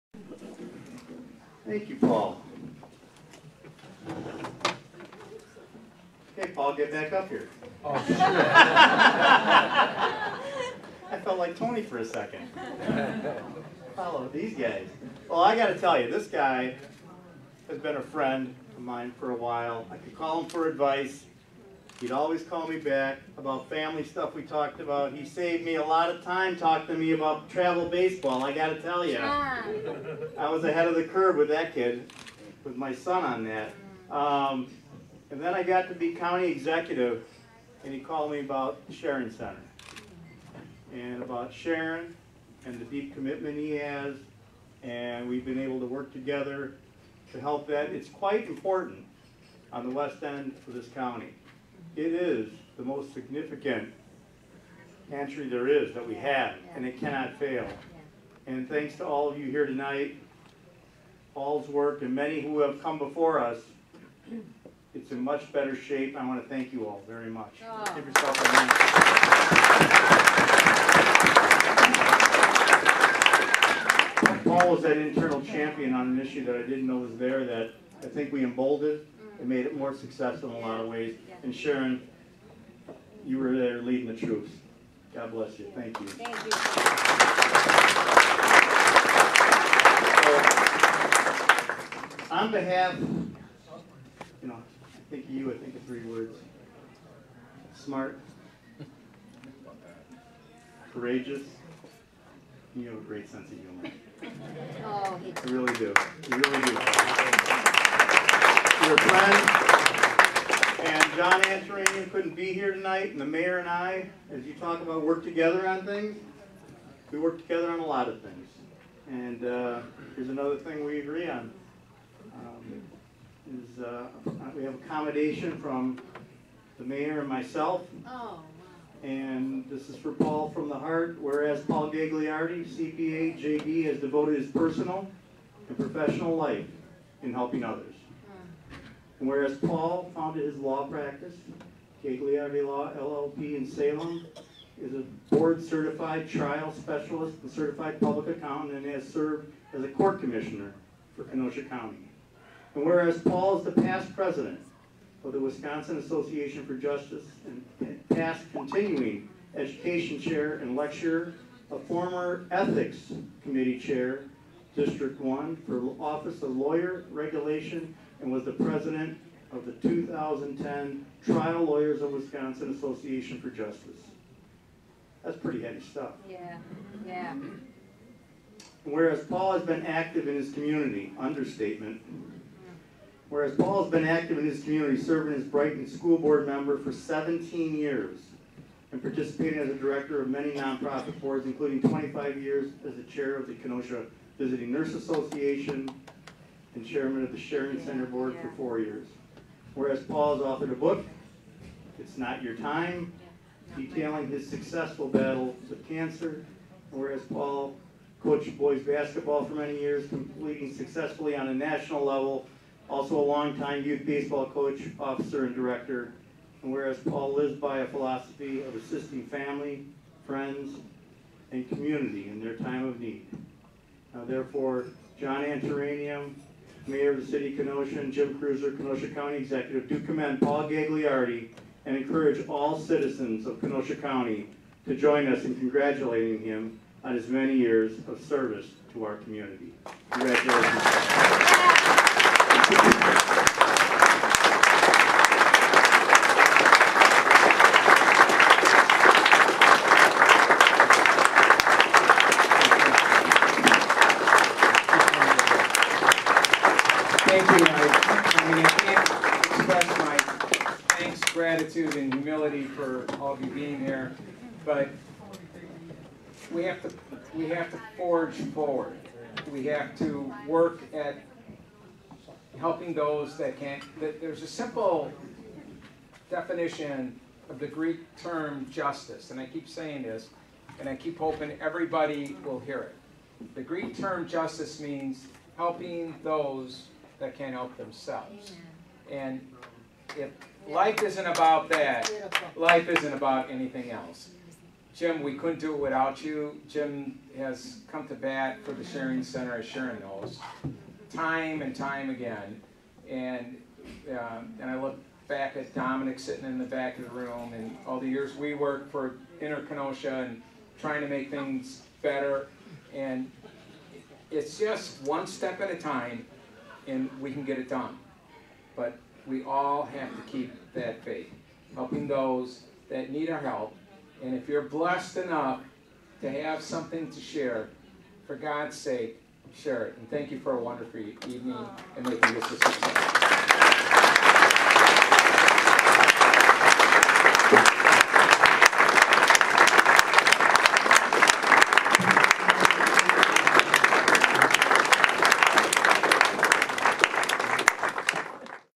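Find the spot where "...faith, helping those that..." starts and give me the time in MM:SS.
05:21.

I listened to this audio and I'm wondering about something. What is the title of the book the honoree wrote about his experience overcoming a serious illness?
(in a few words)
It's Not Your Time.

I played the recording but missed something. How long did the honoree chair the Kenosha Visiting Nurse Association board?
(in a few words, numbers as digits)
25 years.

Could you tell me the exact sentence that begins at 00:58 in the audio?
And thanks to all of you here tonight, Paul's work, and many who have come before us, it's in much better shape.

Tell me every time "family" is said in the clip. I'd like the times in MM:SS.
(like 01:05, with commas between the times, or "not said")
00:23, 03:39.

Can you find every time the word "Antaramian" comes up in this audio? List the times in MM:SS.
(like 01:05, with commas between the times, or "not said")
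01:51, 03:45.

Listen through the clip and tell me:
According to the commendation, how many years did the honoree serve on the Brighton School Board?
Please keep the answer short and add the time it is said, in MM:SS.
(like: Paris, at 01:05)
17, at 03:06.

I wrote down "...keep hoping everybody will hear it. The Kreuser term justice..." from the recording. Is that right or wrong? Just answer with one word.
wrong.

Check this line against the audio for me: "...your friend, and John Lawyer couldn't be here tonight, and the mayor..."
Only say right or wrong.
wrong.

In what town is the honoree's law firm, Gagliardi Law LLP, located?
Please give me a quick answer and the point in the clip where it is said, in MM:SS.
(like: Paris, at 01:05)
Salem, at 02:23.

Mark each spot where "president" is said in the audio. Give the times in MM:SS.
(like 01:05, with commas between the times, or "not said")
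02:34, 02:48.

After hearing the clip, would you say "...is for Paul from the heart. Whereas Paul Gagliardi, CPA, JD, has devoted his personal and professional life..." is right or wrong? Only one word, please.
right.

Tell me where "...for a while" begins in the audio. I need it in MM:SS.
00:19.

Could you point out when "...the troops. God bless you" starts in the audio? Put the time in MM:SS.
01:24.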